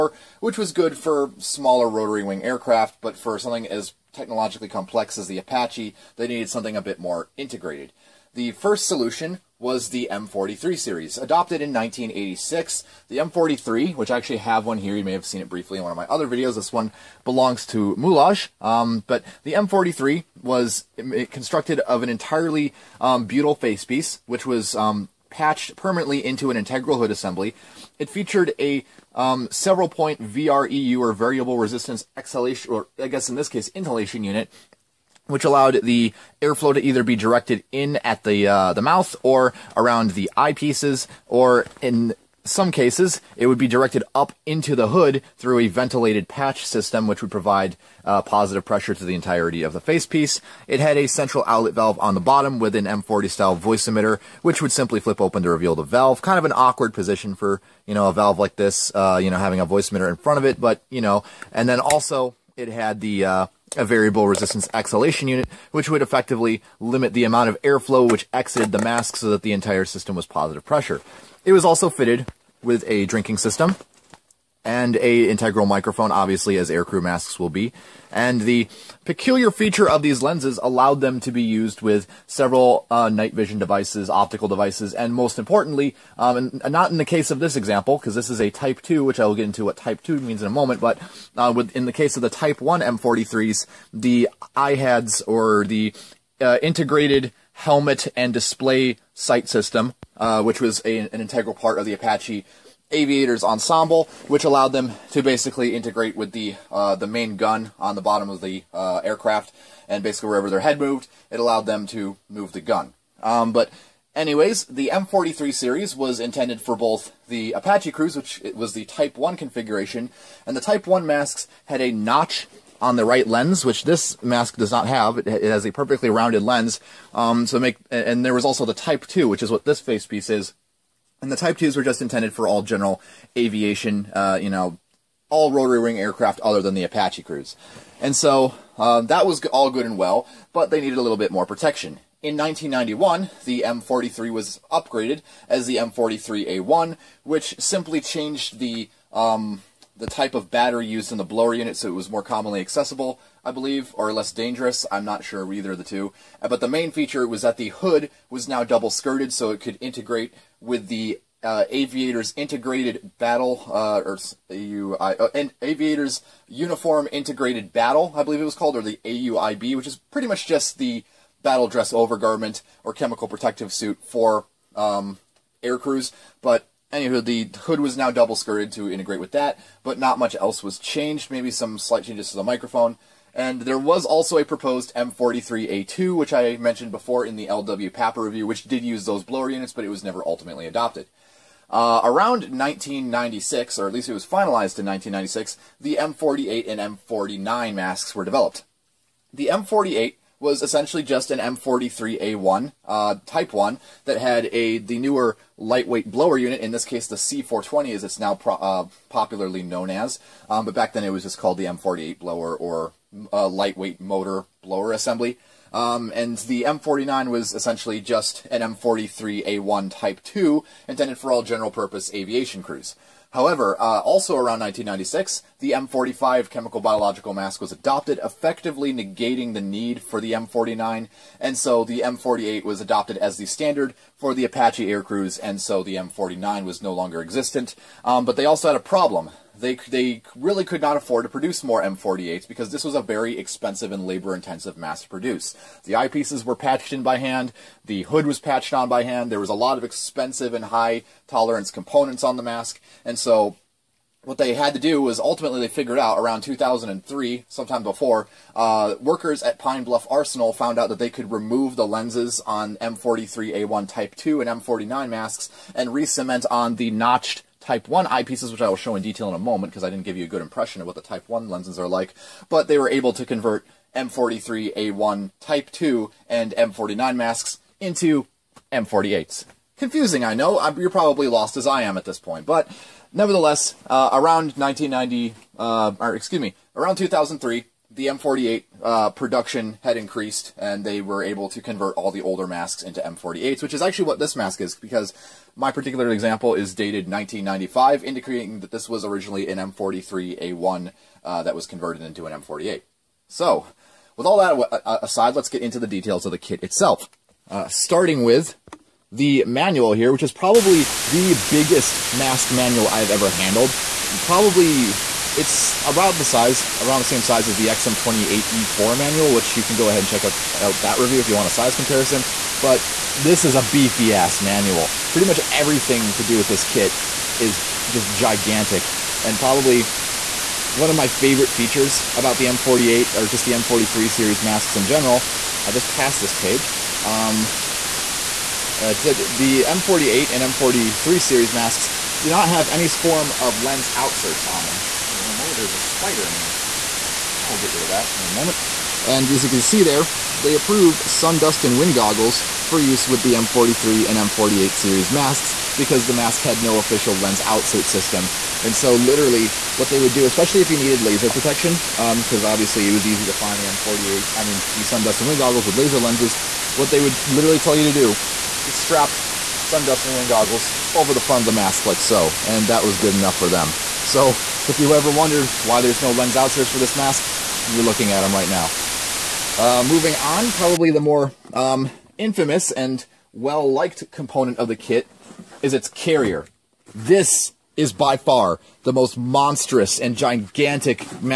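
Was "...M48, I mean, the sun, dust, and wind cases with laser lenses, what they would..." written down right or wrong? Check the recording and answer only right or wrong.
wrong.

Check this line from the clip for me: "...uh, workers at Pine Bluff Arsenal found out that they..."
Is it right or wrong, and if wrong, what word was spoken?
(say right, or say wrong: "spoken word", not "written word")
right.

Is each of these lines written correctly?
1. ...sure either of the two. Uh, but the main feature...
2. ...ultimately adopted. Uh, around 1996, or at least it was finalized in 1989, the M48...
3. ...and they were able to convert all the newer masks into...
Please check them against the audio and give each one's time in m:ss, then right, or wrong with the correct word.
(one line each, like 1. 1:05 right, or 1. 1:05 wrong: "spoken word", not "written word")
1. 2:35 right
2. 3:10 wrong: "1996", not "1989"
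3. 4:50 wrong: "older", not "newer".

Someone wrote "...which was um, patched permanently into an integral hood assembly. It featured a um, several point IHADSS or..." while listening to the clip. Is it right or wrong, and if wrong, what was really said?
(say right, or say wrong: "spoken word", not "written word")
wrong: "VREU", not "IHADSS".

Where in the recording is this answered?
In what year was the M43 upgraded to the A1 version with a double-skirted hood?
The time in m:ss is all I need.
2:22.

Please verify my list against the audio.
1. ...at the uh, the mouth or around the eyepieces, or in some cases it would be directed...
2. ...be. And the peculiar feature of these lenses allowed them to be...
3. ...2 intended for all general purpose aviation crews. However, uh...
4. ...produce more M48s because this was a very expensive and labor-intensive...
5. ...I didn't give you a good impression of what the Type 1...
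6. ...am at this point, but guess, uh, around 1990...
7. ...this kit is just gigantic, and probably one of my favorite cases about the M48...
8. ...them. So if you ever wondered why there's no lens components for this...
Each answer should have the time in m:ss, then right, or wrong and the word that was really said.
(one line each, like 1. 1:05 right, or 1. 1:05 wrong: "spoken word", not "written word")
1. 0:38 right
2. 1:17 right
3. 3:40 right
4. 4:01 right
5. 4:29 right
6. 4:41 wrong: "nevertheless", not "guess"
7. 5:26 wrong: "features", not "cases"
8. 6:13 wrong: "outserts", not "components".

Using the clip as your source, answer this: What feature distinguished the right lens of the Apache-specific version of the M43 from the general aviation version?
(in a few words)
A notch.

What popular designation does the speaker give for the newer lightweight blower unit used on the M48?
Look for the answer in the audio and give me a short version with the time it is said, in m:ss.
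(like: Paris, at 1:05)
C420, at 3:27.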